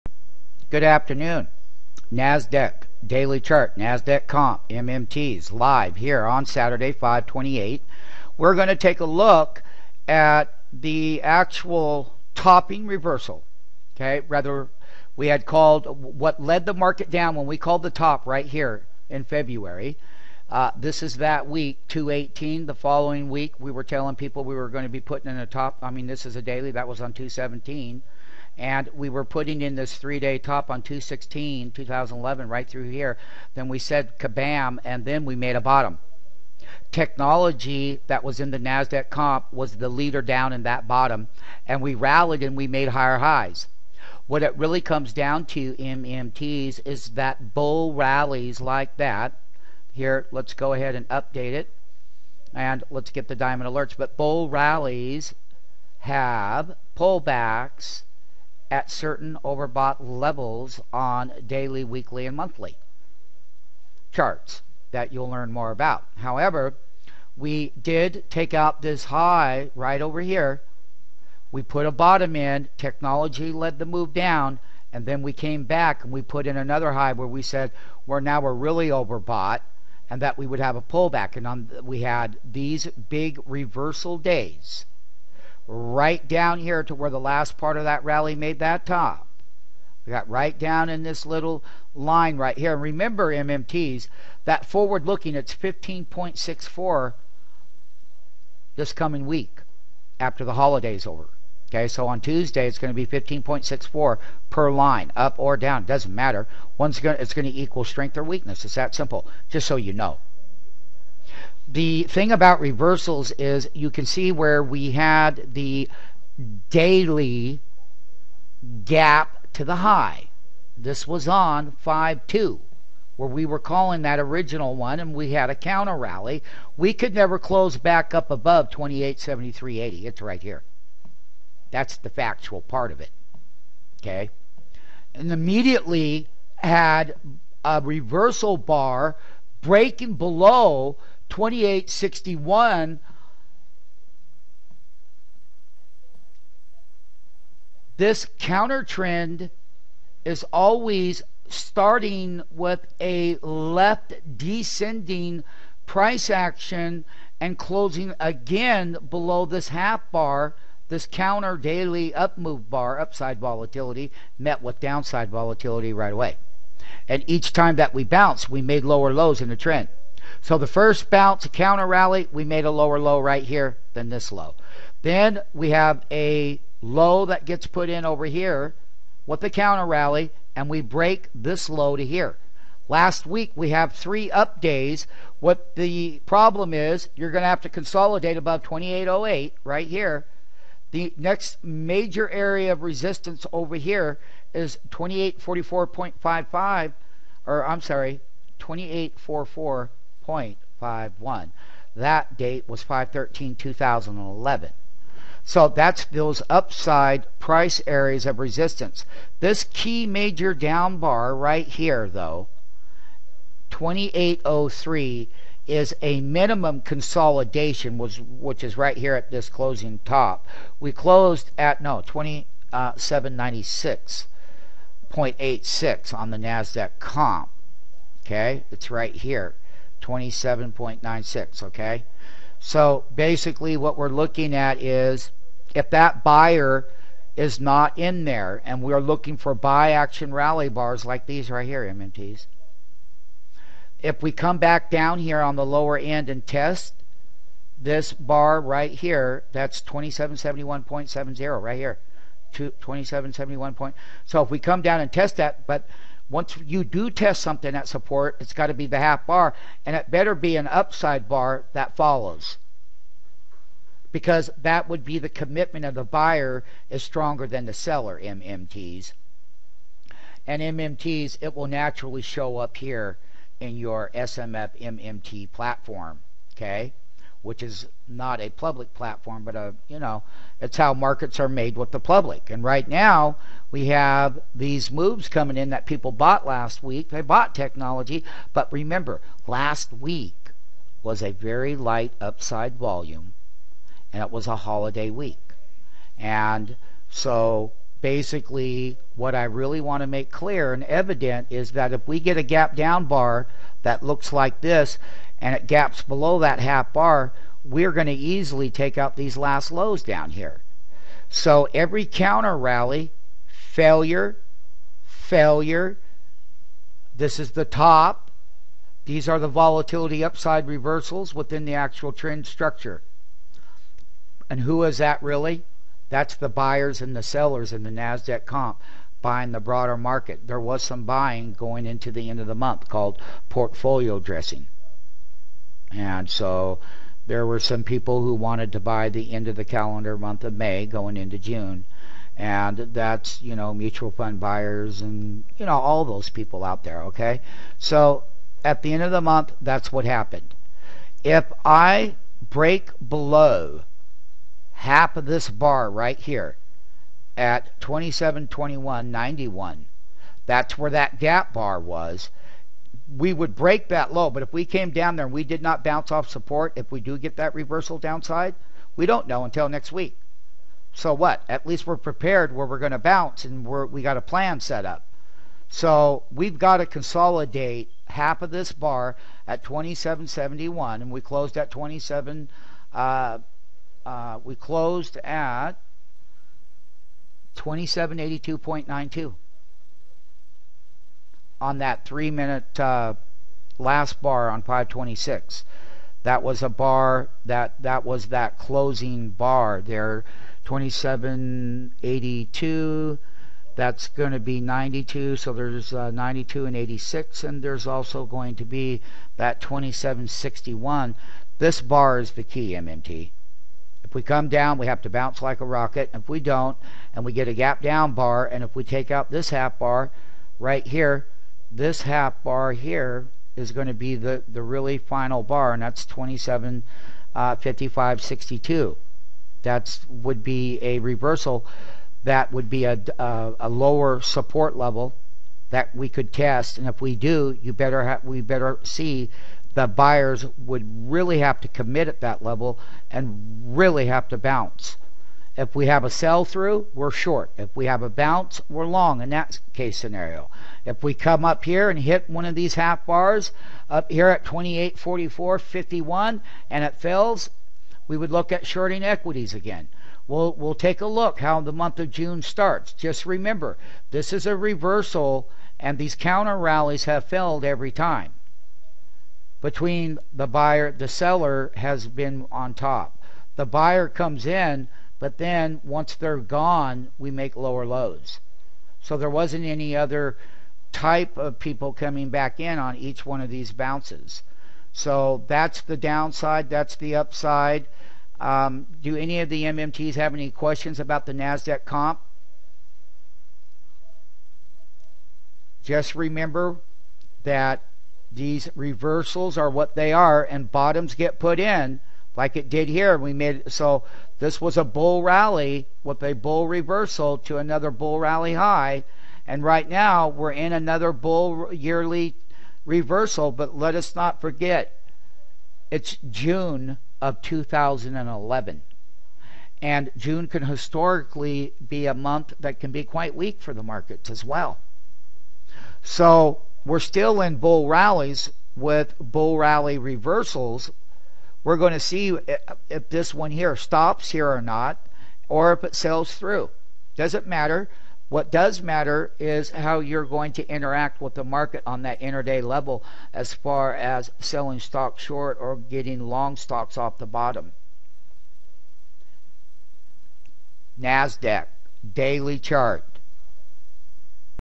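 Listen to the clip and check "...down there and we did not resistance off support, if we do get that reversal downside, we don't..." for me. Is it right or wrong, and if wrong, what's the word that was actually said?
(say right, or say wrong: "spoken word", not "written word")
wrong: "bounce", not "resistance".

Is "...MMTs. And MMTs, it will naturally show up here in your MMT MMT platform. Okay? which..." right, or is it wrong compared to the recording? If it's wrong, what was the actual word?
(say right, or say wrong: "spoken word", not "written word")
wrong: "SMF", not "MMT".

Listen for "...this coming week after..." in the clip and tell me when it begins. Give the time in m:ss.
1:38.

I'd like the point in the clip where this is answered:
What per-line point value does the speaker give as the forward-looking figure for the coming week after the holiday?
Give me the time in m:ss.
1:35.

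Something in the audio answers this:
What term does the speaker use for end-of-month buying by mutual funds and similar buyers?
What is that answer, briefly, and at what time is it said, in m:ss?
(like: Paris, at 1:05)
portfolio dressing, at 5:33.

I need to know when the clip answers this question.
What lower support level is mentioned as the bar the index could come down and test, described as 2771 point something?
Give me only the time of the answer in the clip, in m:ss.
4:09.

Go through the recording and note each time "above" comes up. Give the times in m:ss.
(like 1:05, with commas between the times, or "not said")
2:08, 3:08.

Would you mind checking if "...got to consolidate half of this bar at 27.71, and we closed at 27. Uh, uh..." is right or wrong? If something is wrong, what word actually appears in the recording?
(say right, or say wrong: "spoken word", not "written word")
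right.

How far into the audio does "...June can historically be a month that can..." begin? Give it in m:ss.
8:40.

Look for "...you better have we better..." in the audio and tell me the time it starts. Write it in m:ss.
7:17.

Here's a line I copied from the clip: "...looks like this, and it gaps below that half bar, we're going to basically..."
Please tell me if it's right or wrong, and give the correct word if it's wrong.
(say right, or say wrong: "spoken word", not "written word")
wrong: "easily", not "basically".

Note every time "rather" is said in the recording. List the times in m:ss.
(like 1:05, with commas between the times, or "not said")
0:14.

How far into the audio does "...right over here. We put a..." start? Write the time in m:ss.
1:09.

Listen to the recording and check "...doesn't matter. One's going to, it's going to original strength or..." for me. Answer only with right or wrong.
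wrong.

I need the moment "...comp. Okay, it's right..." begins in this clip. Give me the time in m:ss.
3:46.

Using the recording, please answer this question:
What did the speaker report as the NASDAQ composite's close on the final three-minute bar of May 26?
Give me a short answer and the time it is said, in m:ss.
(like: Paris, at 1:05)
2782.92, at 6:27.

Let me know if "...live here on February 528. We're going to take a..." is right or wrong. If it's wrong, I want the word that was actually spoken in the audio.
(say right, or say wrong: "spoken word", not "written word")
wrong: "Saturday", not "February".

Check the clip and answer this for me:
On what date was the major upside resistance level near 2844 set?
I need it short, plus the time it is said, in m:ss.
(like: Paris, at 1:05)
5/13/2011, at 3:22.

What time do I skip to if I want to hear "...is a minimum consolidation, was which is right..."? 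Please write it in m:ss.
3:35.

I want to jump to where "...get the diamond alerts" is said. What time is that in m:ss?
0:53.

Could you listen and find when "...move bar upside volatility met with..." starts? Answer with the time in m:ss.
2:42.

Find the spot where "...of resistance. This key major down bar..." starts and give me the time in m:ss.
3:28.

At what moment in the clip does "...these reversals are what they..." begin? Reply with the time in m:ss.
8:18.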